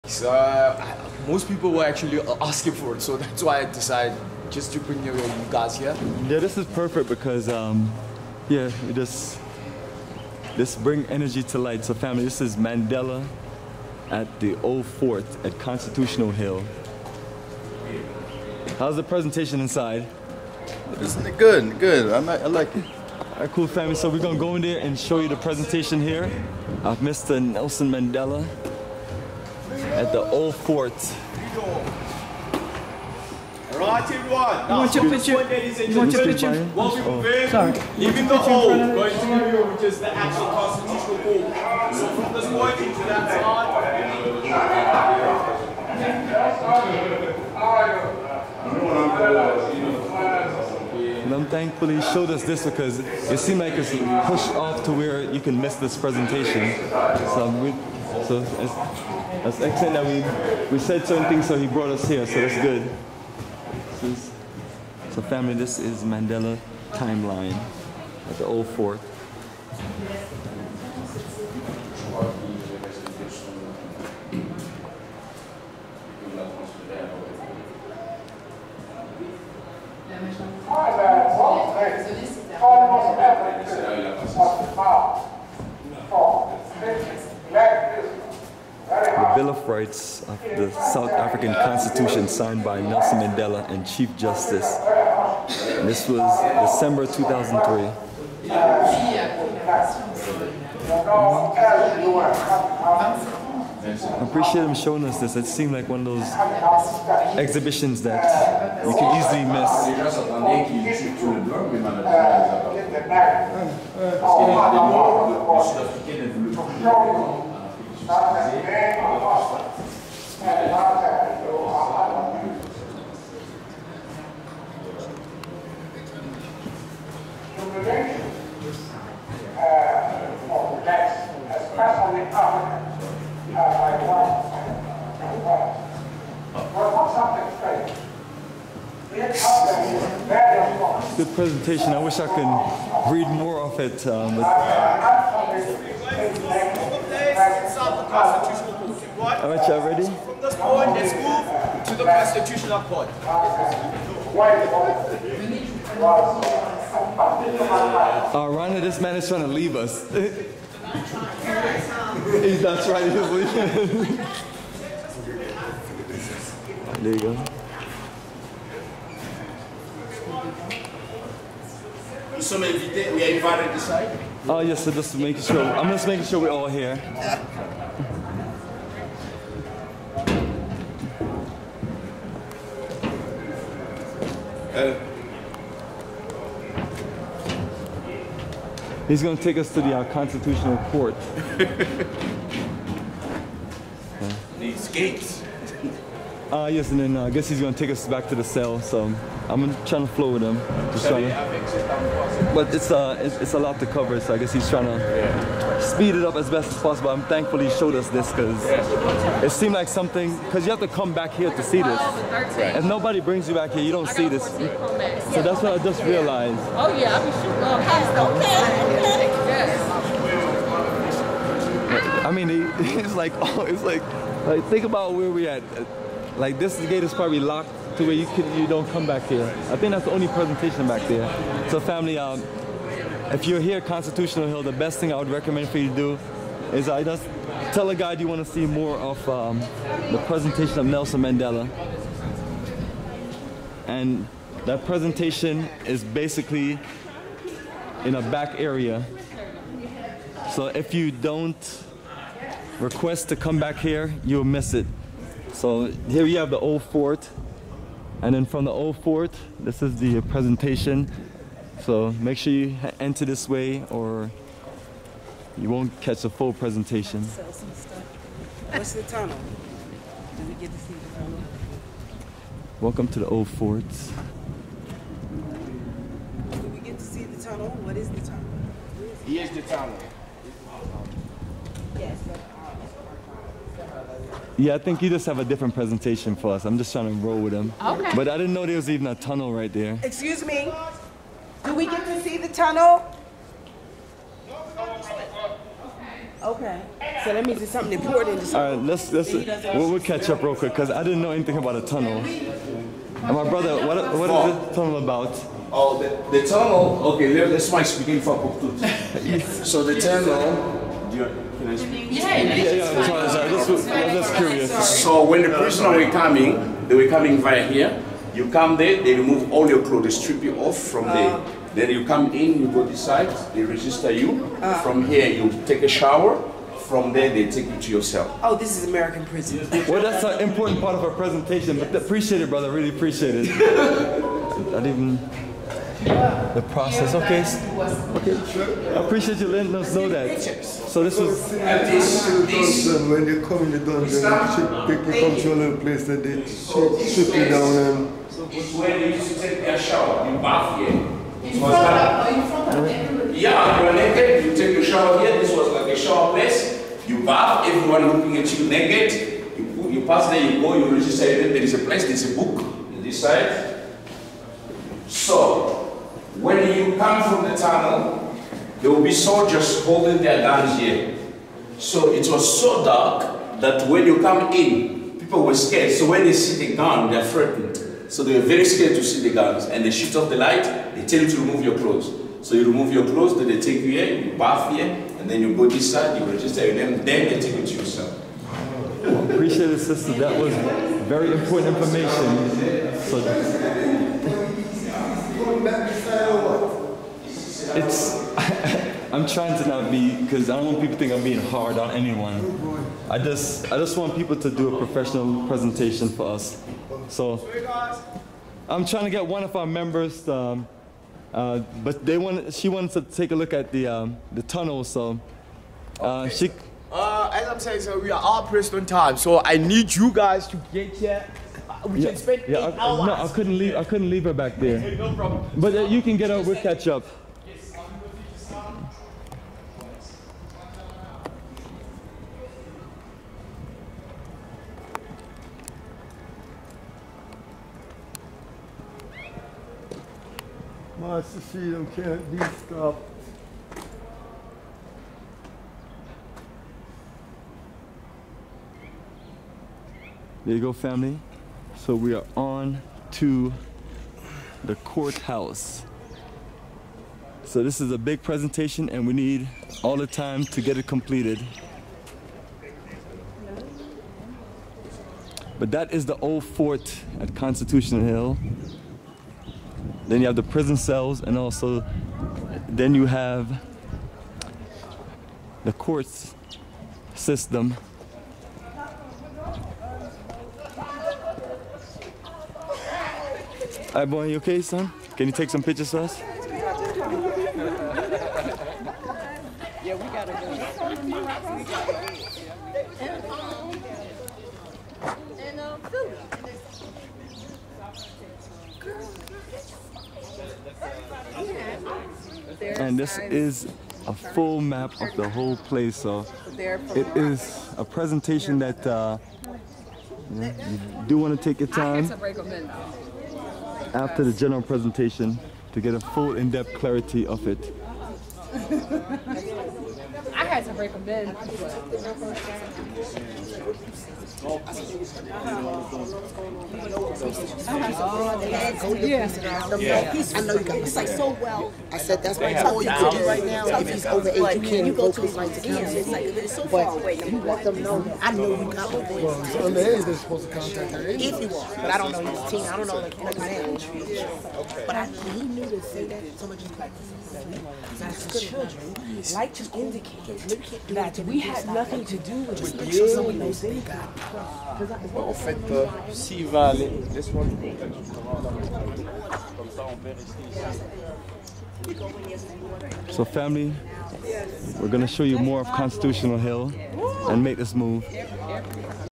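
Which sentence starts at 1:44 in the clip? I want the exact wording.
I appreciate him showing us this.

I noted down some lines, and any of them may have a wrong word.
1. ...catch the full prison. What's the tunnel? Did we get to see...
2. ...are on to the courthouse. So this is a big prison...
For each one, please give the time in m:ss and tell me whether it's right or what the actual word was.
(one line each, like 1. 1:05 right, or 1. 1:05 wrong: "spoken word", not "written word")
1. 4:26 wrong: "presentation", not "prison"
2. 7:32 wrong: "presentation", not "prison".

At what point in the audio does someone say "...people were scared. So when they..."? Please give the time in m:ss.
6:15.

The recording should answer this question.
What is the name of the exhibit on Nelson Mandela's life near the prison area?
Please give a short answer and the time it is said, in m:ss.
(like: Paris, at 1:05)
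Mandela Timeline, at 1:06.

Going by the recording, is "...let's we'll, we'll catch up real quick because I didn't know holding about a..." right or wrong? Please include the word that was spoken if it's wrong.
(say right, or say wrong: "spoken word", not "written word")
wrong: "anything", not "holding".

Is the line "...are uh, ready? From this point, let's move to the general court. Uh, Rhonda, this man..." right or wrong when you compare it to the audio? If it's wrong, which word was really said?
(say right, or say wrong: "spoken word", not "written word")
wrong: "constitutional", not "general".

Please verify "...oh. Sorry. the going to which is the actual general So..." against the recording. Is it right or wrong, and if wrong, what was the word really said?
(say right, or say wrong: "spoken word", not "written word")
wrong: "constitutional", not "general".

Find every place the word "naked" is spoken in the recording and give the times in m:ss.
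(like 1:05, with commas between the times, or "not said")
5:53, 5:58.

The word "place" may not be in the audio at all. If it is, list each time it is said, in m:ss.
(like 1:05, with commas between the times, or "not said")
5:45, 5:56, 6:01, 8:25.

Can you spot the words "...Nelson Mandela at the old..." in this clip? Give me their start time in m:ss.
0:27.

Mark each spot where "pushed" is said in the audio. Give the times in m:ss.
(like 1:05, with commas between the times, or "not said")
0:54.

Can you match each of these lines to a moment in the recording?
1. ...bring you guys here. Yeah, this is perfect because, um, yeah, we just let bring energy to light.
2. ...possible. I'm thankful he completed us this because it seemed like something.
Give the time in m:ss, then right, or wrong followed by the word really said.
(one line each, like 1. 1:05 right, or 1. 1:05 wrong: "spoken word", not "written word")
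1. 0:04 right
2. 3:26 wrong: "showed", not "completed".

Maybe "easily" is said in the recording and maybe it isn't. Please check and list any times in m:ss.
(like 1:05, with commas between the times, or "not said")
1:49.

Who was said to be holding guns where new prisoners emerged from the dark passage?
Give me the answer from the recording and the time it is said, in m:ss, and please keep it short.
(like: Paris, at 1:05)
soldiers, at 6:09.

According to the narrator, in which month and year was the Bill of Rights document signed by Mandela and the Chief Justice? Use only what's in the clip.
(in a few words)
December 2003.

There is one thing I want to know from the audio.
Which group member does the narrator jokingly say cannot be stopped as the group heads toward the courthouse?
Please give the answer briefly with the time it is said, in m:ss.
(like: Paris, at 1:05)
Master Shido, at 7:20.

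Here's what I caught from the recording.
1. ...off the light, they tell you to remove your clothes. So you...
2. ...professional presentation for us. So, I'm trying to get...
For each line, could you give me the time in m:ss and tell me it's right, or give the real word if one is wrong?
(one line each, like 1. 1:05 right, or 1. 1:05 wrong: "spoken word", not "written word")
1. 6:20 right
2. 6:44 right.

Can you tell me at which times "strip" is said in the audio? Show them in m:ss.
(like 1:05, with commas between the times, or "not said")
5:20, 5:46.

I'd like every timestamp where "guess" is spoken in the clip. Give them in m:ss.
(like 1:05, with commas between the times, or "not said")
3:17, 3:24.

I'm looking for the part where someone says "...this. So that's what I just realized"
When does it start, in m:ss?
3:34.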